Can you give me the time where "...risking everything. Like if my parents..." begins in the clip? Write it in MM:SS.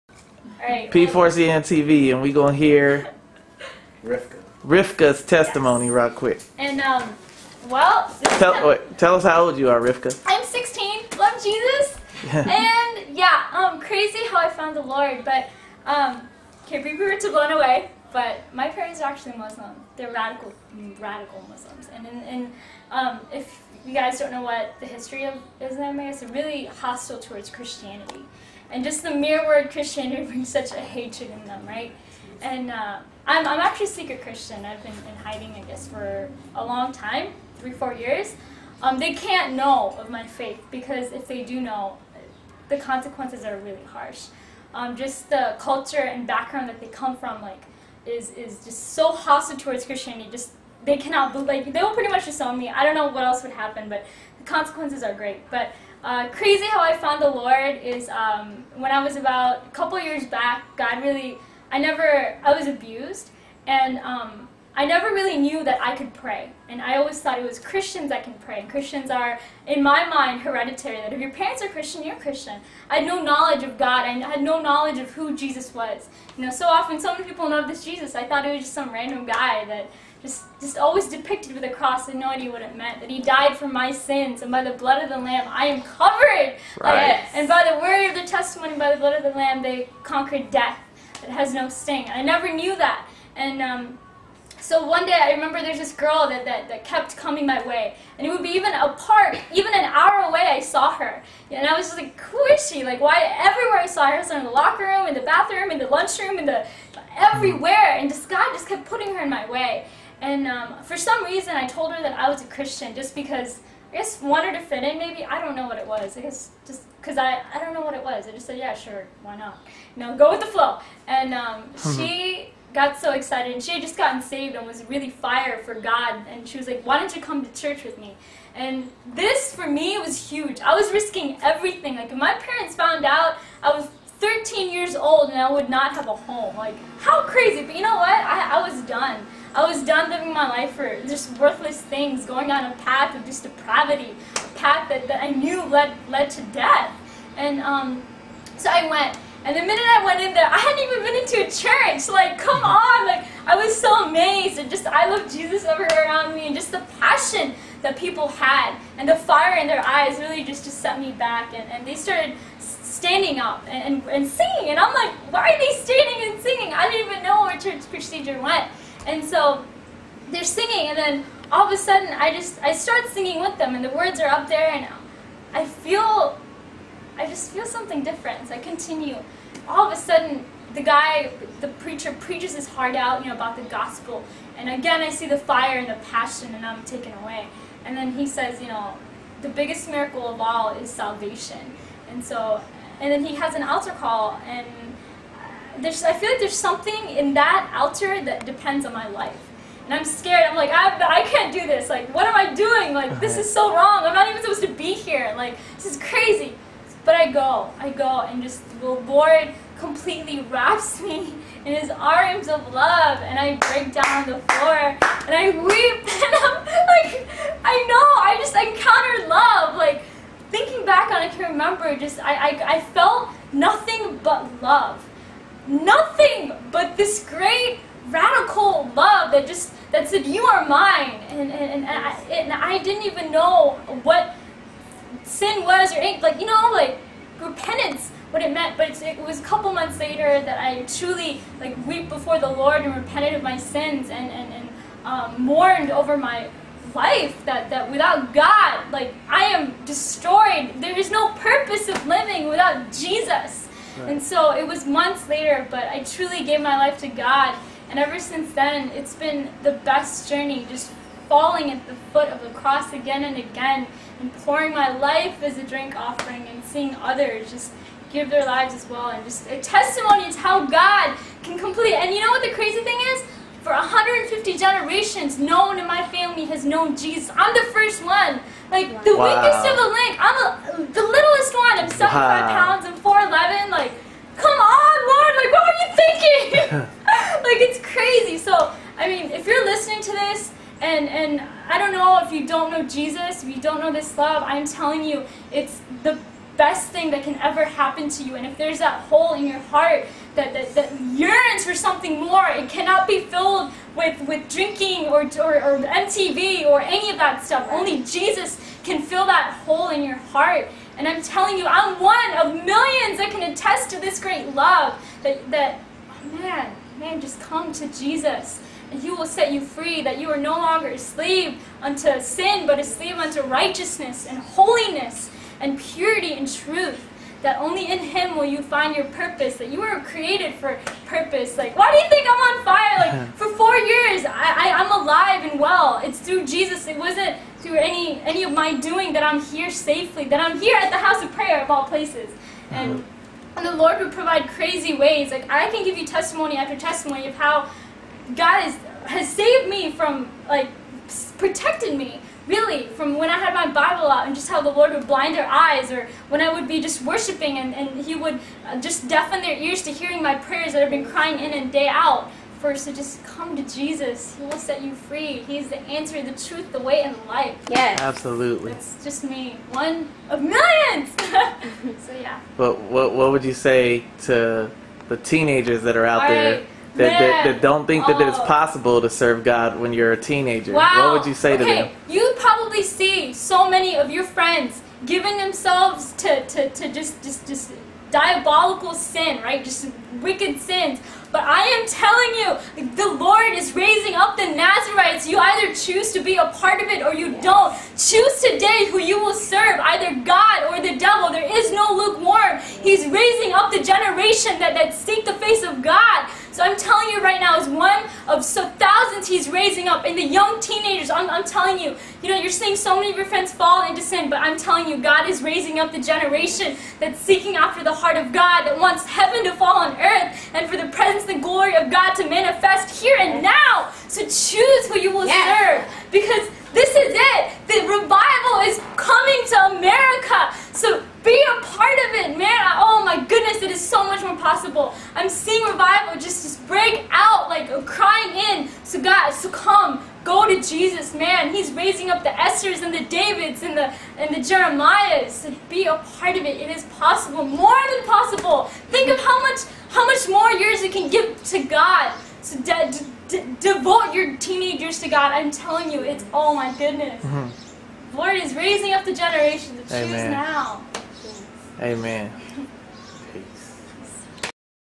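02:10.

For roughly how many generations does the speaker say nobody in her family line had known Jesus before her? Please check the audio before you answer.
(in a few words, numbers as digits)
150.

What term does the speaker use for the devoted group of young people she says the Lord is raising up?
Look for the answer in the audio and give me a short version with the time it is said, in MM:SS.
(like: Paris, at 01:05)
Nazarites, at 06:34.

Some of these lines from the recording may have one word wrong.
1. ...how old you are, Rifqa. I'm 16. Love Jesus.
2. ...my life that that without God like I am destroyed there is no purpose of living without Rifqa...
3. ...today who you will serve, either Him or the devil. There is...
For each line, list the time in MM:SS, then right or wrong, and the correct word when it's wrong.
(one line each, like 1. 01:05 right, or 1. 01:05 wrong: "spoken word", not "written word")
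1. 00:09 right
2. 04:06 wrong: "Jesus", not "Rifqa"
3. 06:38 wrong: "God", not "Him".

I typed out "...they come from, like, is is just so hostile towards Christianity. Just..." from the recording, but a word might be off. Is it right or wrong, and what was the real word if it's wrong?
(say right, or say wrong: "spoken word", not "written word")
right.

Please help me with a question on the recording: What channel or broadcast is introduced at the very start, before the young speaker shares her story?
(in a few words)
P4CN TV.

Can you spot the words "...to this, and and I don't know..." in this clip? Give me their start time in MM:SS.
04:50.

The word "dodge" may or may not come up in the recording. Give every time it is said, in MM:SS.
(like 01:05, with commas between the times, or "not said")
not said.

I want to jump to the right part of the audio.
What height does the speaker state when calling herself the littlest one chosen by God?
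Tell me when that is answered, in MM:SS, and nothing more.
04:42.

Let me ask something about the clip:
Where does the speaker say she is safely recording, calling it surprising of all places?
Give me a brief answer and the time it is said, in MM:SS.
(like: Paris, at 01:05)
House of prayer, at 05:40.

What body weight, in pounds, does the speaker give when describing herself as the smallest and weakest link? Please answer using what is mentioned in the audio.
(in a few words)
75.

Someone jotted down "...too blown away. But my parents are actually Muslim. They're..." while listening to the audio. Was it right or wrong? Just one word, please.
right.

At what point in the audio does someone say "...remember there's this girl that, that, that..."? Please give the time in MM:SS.
01:35.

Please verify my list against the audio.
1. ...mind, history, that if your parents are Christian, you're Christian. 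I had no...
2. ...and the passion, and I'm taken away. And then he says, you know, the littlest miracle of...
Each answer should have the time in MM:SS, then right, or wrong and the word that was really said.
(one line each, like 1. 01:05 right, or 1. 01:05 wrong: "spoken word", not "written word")
1. 01:10 wrong: "hereditary", not "history"
2. 03:05 wrong: "biggest", not "littlest".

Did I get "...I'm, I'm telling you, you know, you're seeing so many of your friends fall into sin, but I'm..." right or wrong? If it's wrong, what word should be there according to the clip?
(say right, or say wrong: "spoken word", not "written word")
right.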